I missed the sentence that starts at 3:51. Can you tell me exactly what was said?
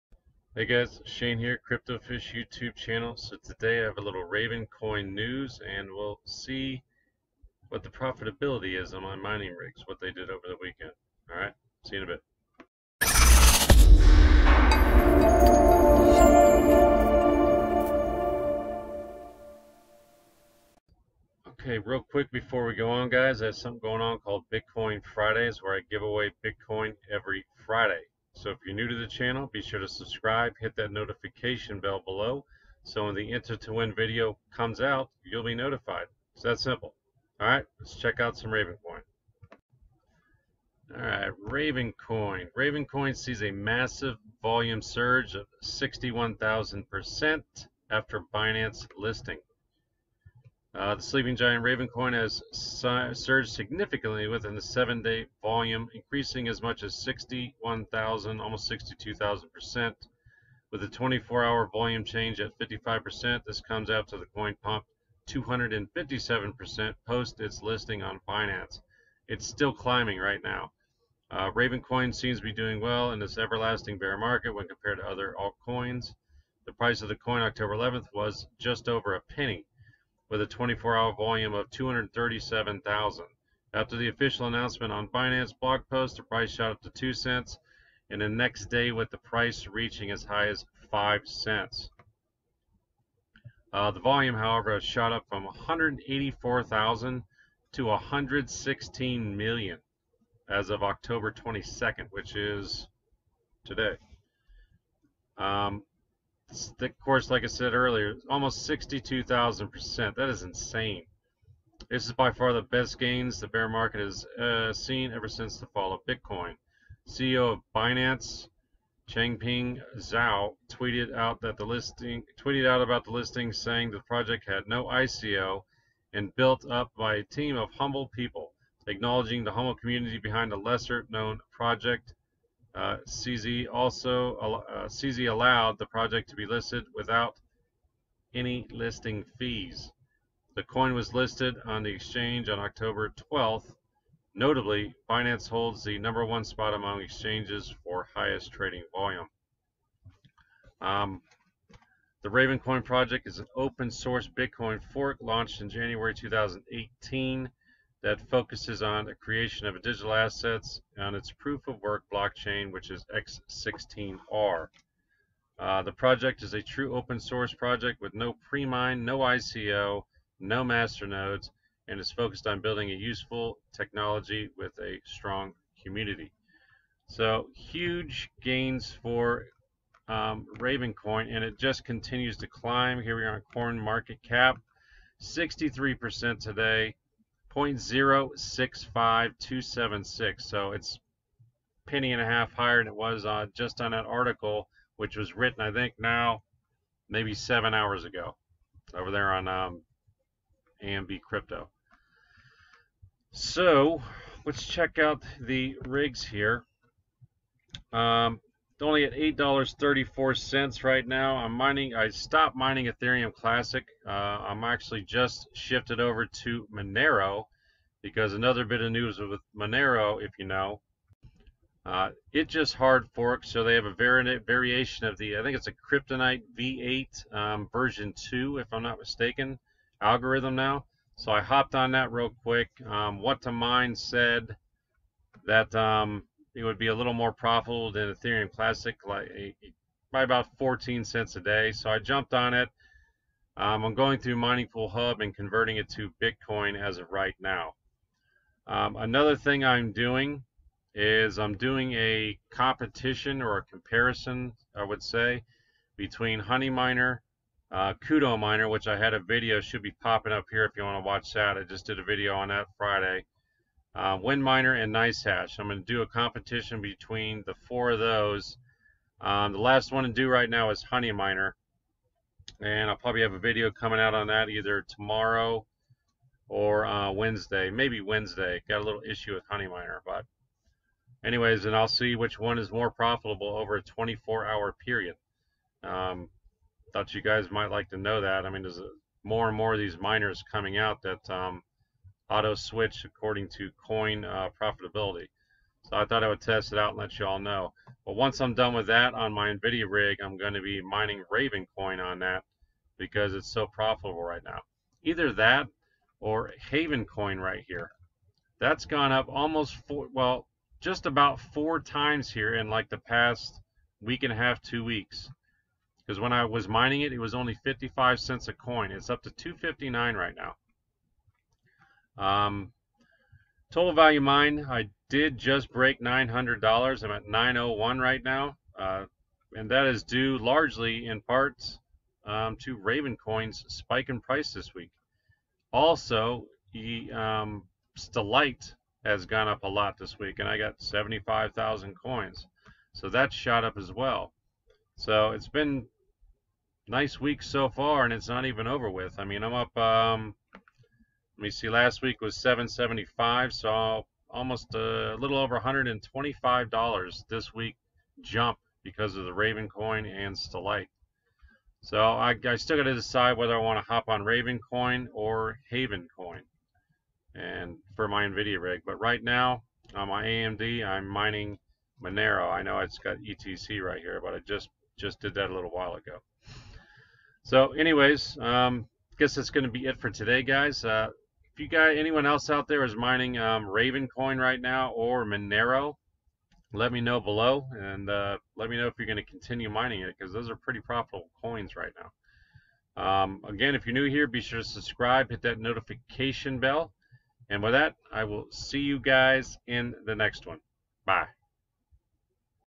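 So I hopped on that real quick.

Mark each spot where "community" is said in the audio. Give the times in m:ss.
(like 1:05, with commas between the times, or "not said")
2:09, 2:55.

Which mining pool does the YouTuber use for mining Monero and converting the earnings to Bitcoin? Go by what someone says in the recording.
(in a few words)
Mining Pool Hub.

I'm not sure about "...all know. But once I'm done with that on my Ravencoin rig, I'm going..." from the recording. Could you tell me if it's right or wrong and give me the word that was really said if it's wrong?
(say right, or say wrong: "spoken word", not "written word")
wrong: "NVIDIA", not "Ravencoin".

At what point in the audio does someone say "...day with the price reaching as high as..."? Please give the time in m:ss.
1:28.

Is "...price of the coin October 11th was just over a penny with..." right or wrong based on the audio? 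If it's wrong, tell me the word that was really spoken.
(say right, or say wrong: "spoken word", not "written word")
right.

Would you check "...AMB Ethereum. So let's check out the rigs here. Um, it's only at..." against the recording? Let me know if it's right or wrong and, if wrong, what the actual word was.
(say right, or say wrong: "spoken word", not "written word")
wrong: "Crypto", not "Ethereum".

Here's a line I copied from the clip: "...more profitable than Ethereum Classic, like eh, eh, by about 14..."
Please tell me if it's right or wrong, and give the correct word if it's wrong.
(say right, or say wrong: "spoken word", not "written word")
right.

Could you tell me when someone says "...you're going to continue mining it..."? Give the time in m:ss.
6:28.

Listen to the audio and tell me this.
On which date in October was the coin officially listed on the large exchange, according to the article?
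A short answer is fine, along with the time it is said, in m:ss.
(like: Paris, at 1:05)
October 12th, at 2:22.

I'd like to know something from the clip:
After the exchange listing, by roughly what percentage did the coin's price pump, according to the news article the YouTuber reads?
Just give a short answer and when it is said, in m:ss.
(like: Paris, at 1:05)
257%, at 1:05.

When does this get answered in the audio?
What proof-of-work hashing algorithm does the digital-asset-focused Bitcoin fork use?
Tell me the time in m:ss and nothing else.
2:43.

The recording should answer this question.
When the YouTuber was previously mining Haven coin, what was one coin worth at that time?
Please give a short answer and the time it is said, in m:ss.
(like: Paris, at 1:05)
55 cents, at 5:17.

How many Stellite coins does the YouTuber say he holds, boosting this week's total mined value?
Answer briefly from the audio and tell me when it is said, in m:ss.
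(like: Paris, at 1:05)
75,000, at 5:40.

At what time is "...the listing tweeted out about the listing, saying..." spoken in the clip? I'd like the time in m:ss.
2:01.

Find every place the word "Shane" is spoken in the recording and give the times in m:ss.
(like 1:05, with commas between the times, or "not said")
0:01.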